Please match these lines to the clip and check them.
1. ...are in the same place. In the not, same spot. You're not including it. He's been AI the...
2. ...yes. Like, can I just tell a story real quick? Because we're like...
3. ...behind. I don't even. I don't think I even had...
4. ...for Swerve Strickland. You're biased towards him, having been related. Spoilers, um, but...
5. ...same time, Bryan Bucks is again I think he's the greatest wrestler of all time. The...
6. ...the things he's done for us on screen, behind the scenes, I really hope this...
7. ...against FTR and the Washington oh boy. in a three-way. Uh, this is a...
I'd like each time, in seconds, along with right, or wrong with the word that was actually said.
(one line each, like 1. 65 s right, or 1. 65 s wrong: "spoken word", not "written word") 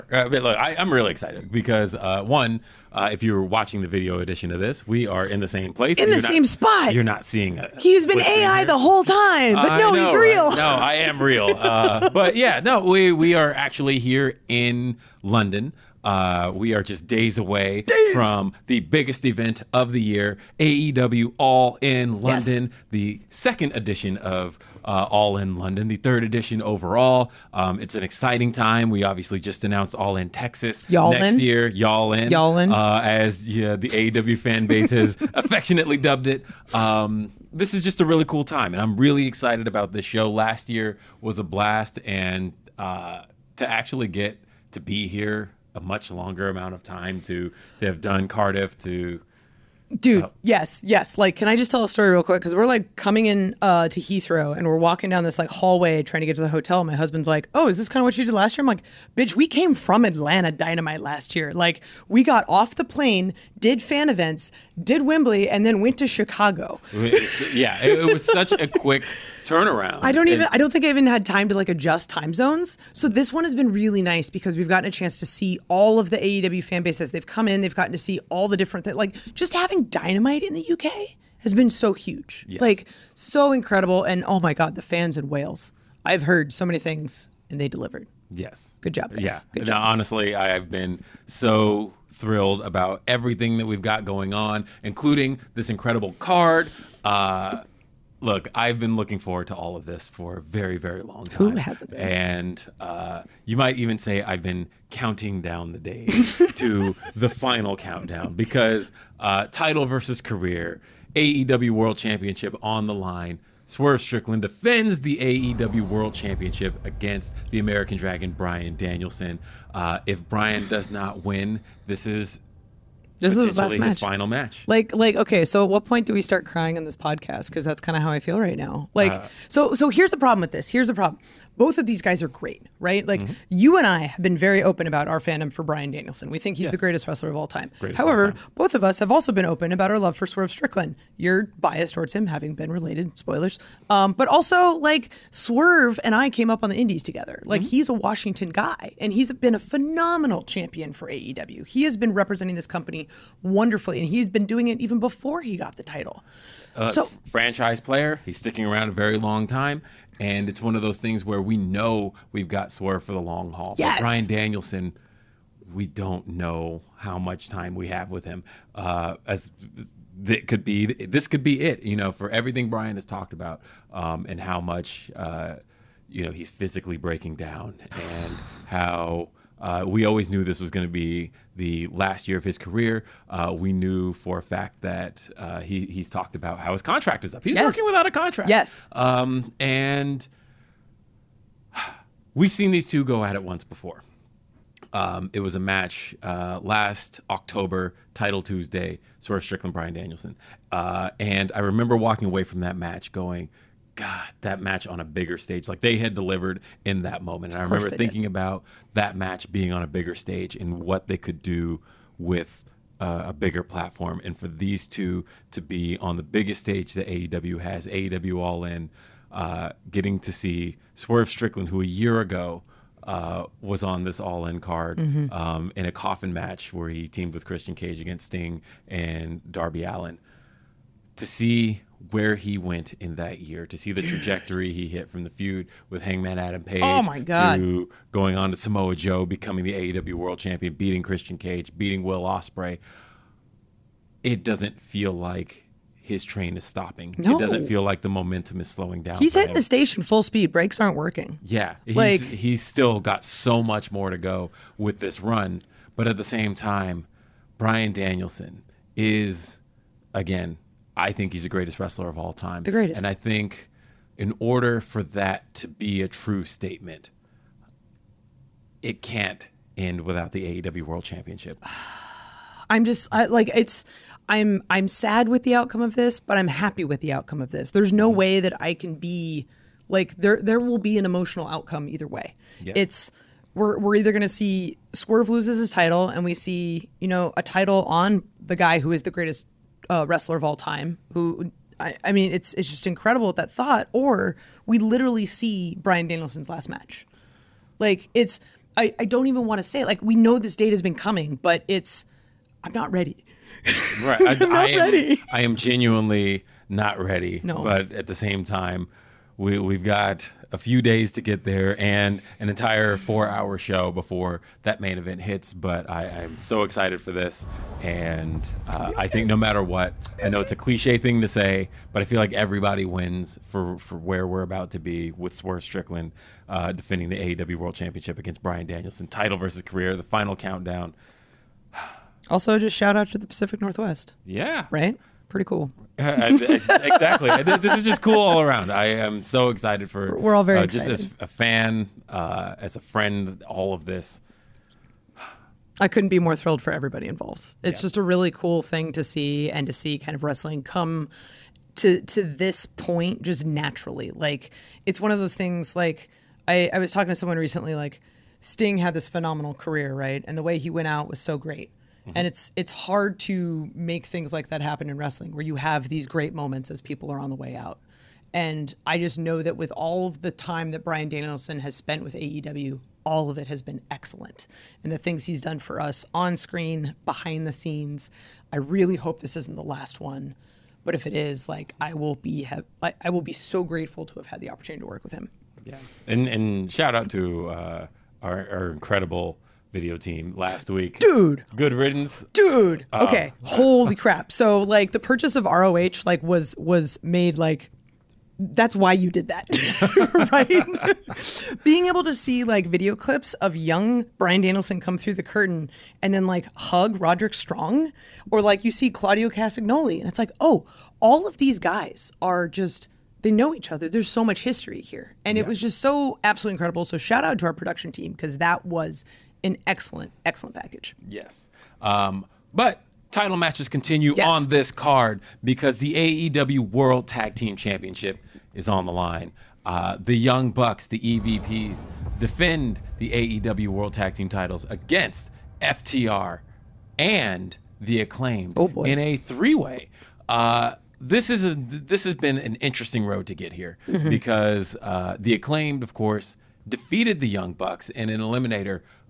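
1. 5 s wrong: "seeing", not "including"
2. 50 s right
3. 69 s wrong: "turnaround", not "behind"
4. 140 s right
5. 256 s wrong: "Danielson", not "Bucks"
6. 374 s right
7. 434 s wrong: "Acclaimed", not "Washington".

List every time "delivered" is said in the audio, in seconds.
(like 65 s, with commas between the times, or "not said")
87 s, 206 s.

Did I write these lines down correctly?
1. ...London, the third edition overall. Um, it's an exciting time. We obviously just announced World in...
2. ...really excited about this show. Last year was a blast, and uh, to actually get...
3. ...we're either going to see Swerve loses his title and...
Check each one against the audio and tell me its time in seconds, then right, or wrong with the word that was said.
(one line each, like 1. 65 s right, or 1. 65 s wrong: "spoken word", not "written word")
1. 25 s wrong: "All", not "World"
2. 38 s right
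3. 283 s right.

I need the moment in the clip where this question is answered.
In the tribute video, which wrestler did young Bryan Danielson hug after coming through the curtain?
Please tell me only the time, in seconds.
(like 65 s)
406 s.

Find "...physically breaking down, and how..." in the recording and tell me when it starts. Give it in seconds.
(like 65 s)
176 s.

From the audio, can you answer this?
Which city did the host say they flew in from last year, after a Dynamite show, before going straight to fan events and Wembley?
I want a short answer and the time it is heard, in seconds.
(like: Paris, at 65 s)
Atlanta, at 60 s.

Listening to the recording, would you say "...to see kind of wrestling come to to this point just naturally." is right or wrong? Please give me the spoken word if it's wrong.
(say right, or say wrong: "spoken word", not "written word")
right.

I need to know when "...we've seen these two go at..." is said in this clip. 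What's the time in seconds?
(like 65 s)
192 s.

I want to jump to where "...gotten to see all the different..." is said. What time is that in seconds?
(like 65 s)
77 s.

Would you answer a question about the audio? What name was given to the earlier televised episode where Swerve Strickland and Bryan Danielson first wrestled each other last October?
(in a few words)
Title Tuesday.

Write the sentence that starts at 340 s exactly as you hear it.
We're all very uh, just excited.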